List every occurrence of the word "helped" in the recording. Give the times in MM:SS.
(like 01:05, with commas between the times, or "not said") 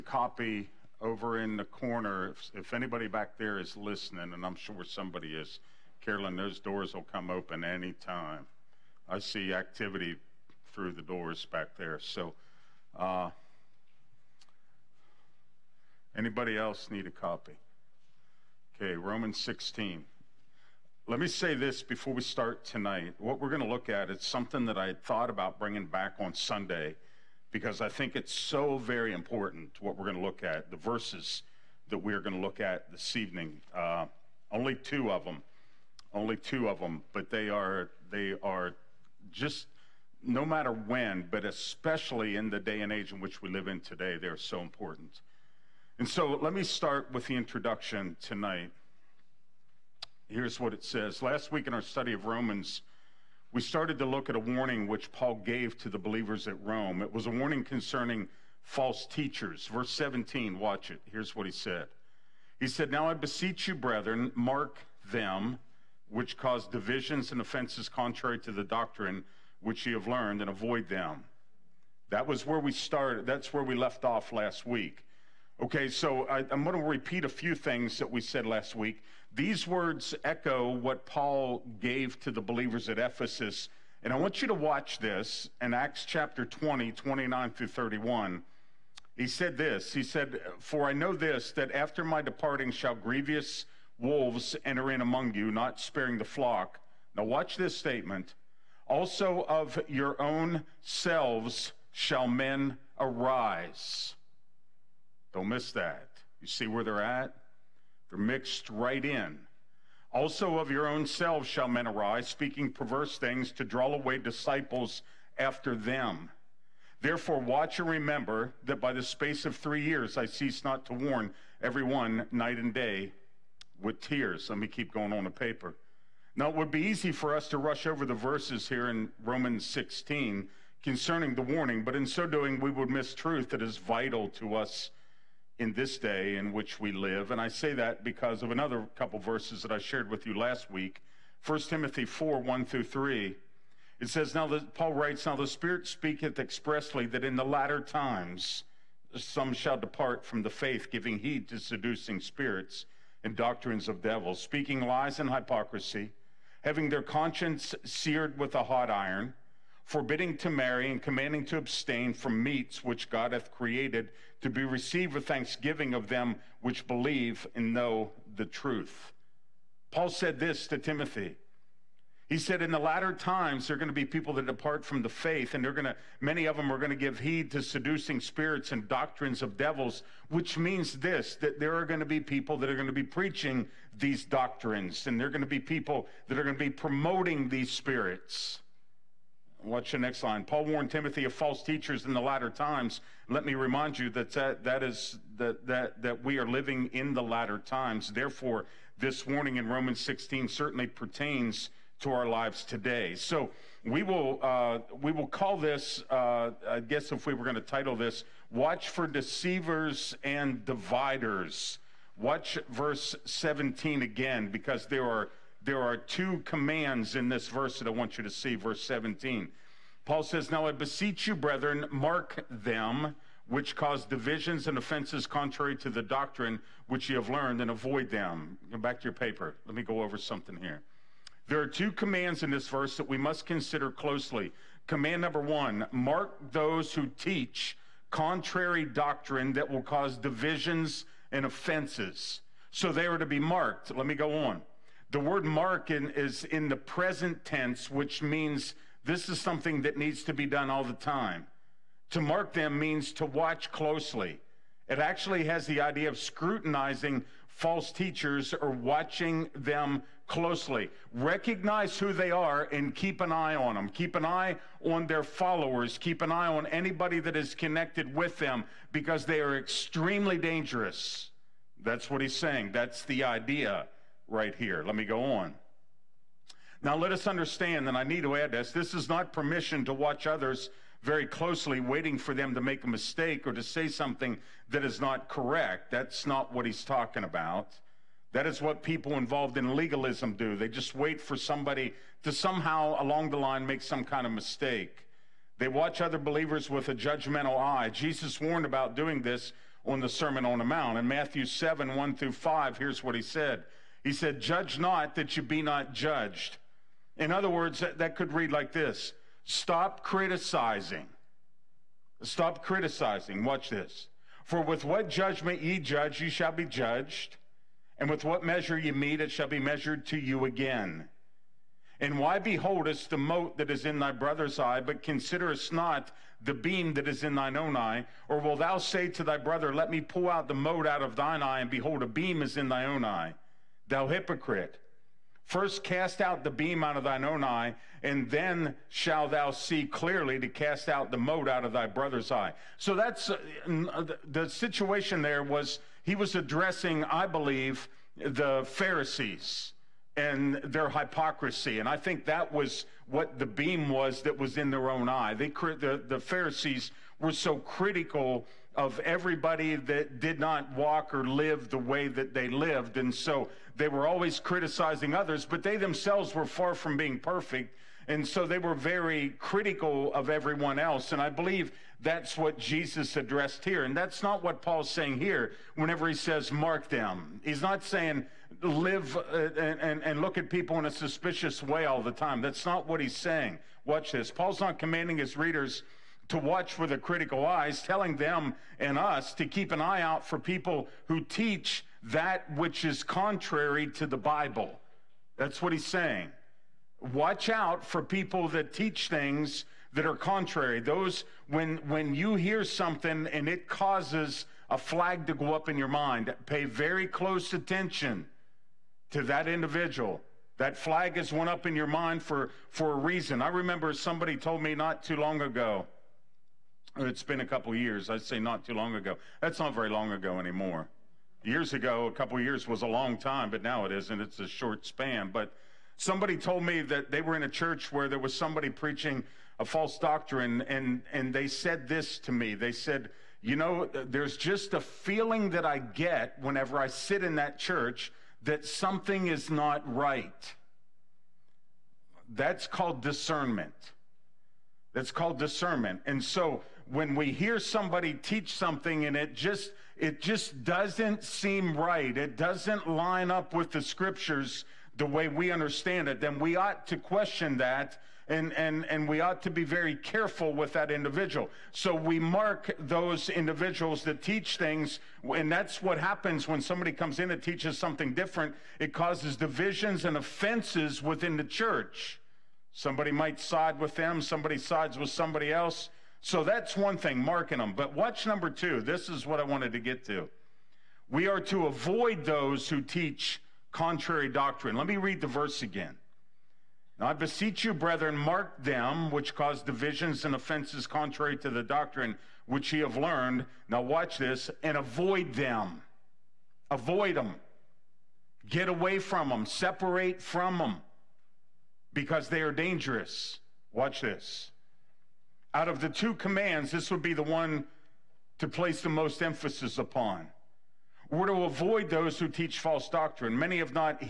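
not said.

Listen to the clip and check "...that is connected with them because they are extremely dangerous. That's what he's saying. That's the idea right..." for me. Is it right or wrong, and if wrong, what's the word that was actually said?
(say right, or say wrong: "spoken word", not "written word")
right.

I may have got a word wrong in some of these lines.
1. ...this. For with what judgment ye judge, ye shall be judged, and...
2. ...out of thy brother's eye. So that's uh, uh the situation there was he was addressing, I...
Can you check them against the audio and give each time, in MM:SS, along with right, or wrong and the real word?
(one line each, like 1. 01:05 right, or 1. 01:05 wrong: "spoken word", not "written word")
1. 05:13 right
2. 05:41 right.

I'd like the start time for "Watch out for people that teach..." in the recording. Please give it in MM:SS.
06:37.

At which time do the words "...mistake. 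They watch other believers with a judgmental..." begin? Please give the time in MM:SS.
04:54.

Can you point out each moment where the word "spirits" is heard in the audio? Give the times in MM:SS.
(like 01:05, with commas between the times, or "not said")
02:25, 02:32, 02:58, 03:07.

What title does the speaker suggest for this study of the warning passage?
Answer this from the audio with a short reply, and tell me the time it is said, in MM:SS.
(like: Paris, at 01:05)
Watch for Deceivers and Dividers, at 03:28.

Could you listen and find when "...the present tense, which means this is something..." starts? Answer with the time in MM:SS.
04:06.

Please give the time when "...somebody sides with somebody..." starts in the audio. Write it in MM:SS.
07:54.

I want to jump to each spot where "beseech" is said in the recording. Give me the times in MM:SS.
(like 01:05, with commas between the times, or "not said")
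01:03, 03:40, 08:07.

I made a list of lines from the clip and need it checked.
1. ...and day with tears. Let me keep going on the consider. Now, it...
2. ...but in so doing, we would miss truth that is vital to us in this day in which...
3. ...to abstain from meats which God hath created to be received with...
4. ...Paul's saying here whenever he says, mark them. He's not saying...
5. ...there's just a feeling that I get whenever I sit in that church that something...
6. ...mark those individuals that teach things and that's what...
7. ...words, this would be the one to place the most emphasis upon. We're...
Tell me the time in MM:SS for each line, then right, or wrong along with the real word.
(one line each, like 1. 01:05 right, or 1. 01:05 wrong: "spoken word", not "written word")
1. 02:02 wrong: "paper", not "consider"
2. 02:11 right
3. 02:41 right
4. 06:14 right
5. 07:14 right
6. 07:42 right
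7. 08:26 wrong: "commands", not "words".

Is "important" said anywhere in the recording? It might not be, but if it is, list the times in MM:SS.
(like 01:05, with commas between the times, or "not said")
00:29, 00:44.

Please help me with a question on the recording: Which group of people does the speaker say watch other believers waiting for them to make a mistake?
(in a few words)
people involved in legalism.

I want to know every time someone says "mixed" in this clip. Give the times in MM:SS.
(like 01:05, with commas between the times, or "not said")
01:48.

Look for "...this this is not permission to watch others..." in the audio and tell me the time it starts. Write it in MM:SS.
04:38.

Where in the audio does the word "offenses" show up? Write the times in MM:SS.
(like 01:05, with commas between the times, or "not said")
01:07, 03:44, 04:01, 07:50, 08:10.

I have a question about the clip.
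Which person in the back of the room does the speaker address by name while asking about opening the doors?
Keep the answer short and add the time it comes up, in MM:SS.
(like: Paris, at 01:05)
Carolyn, at 00:06.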